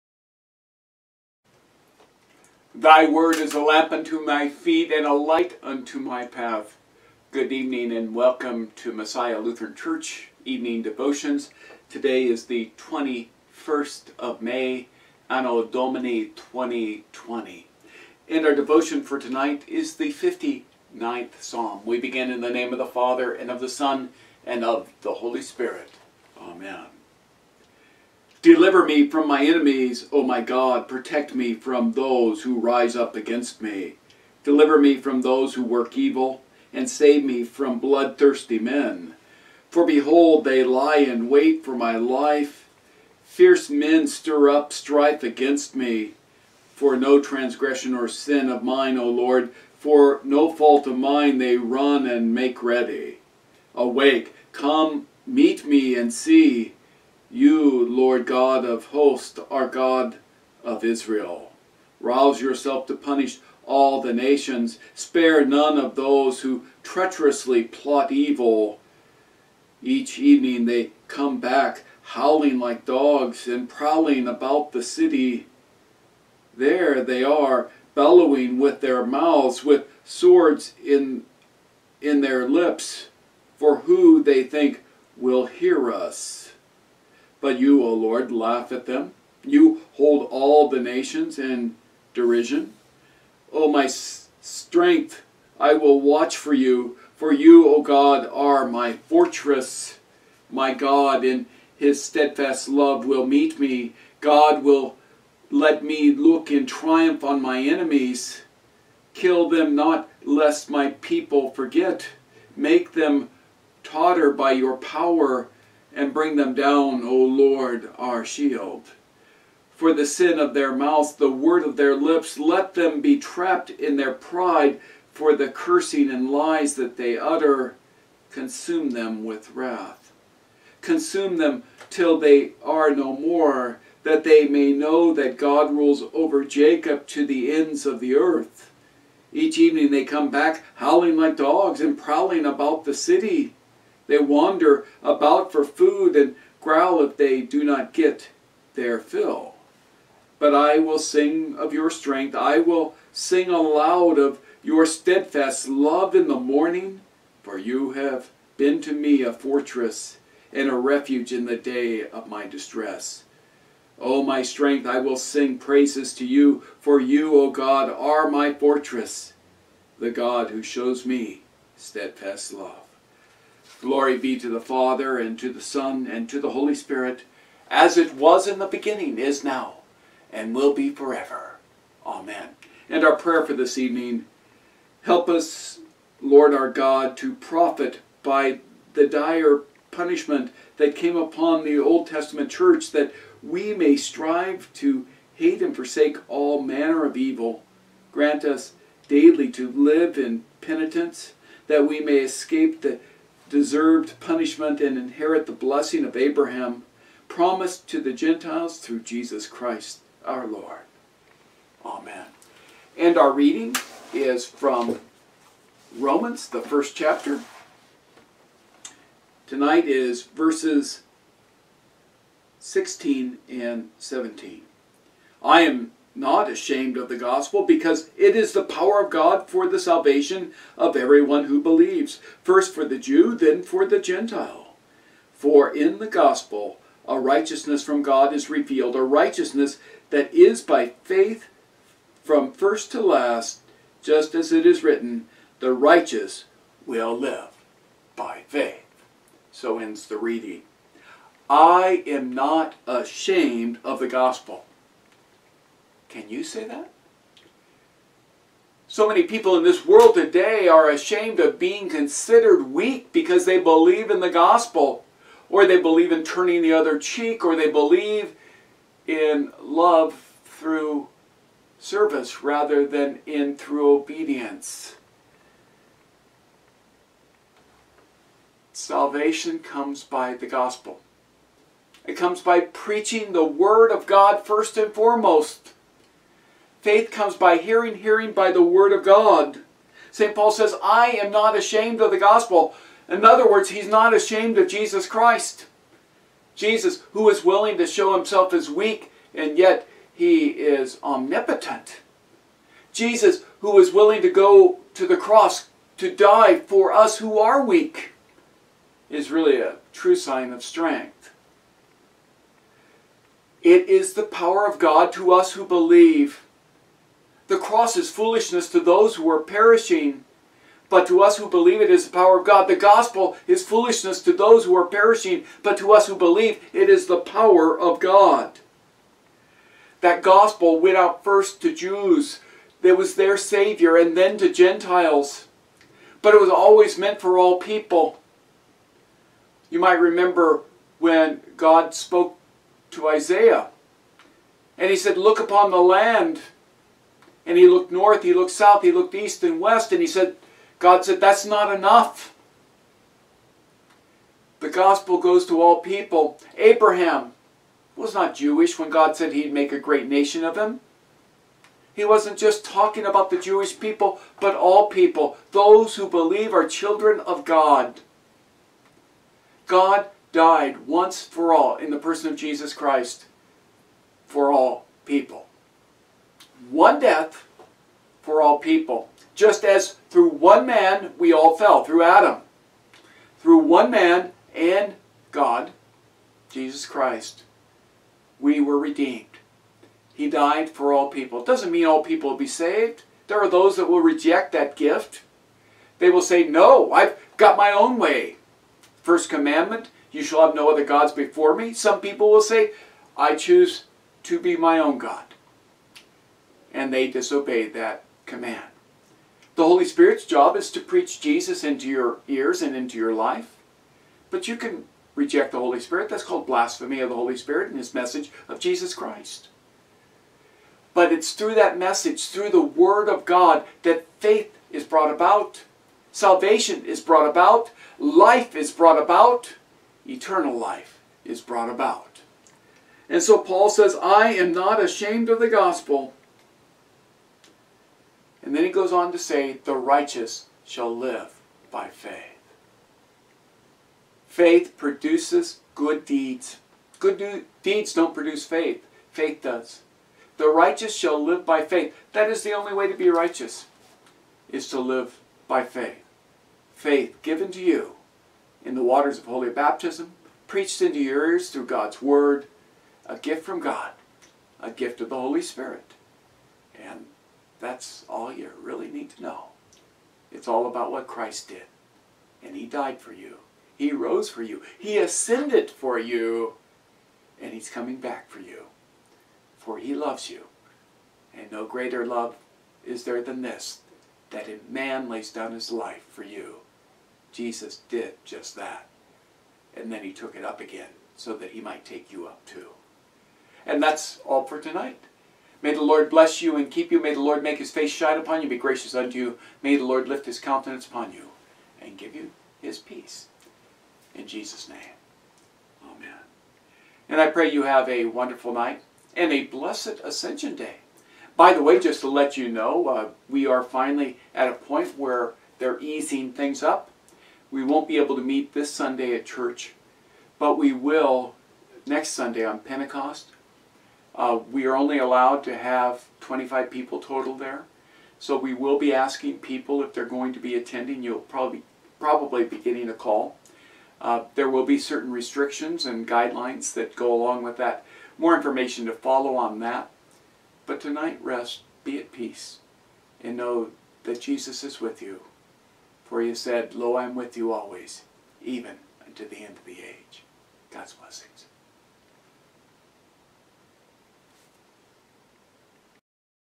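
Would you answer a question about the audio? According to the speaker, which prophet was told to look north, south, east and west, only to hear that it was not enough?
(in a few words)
Isaiah.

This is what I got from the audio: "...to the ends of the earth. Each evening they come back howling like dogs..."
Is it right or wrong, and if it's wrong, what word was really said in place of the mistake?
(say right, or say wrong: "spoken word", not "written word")
right.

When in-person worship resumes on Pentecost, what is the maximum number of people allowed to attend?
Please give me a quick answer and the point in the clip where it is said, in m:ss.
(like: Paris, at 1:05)
25, at 8:46.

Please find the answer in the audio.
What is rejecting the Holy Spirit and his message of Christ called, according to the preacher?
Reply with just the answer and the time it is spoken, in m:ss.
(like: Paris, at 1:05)
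Blasphemy of the Holy Spirit, at 6:56.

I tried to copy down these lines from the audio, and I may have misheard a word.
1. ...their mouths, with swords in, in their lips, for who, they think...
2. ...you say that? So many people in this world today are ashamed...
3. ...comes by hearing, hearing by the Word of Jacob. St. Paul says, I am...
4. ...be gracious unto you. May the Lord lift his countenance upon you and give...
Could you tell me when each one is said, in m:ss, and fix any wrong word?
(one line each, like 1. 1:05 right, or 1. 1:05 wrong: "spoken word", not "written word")
1. 1:18 right
2. 4:16 right
3. 4:47 wrong: "God", not "Jacob"
4. 8:18 right.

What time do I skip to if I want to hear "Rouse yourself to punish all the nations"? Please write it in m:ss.
1:02.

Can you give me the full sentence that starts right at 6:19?
Just as through one man we all fell, through Adam.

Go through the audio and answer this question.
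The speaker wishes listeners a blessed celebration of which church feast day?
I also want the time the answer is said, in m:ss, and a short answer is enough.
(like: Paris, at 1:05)
Ascension Day, at 8:30.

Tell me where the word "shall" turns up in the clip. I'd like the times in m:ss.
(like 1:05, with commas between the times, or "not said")
6:40, 7:20, 7:30.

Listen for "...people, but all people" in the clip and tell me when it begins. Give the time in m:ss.
6:03.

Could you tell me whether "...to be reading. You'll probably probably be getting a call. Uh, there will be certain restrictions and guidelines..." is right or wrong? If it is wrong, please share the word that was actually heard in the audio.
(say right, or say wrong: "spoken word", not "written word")
wrong: "attending", not "reading".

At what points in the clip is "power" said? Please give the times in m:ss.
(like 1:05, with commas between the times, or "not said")
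1:54, 3:48, 5:14, 5:22, 5:27.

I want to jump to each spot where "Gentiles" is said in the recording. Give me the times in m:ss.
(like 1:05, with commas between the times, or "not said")
3:28, 3:53, 5:34.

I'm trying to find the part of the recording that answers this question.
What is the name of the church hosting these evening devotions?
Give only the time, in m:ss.
0:08.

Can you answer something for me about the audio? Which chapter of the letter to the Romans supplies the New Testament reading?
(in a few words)
First chapter.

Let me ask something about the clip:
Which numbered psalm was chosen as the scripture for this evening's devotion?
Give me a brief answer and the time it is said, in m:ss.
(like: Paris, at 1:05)
59, at 0:20.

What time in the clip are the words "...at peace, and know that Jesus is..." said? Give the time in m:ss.
9:01.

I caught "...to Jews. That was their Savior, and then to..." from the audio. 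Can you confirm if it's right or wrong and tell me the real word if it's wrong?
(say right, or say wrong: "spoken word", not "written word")
right.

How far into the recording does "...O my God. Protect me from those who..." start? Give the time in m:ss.
0:30.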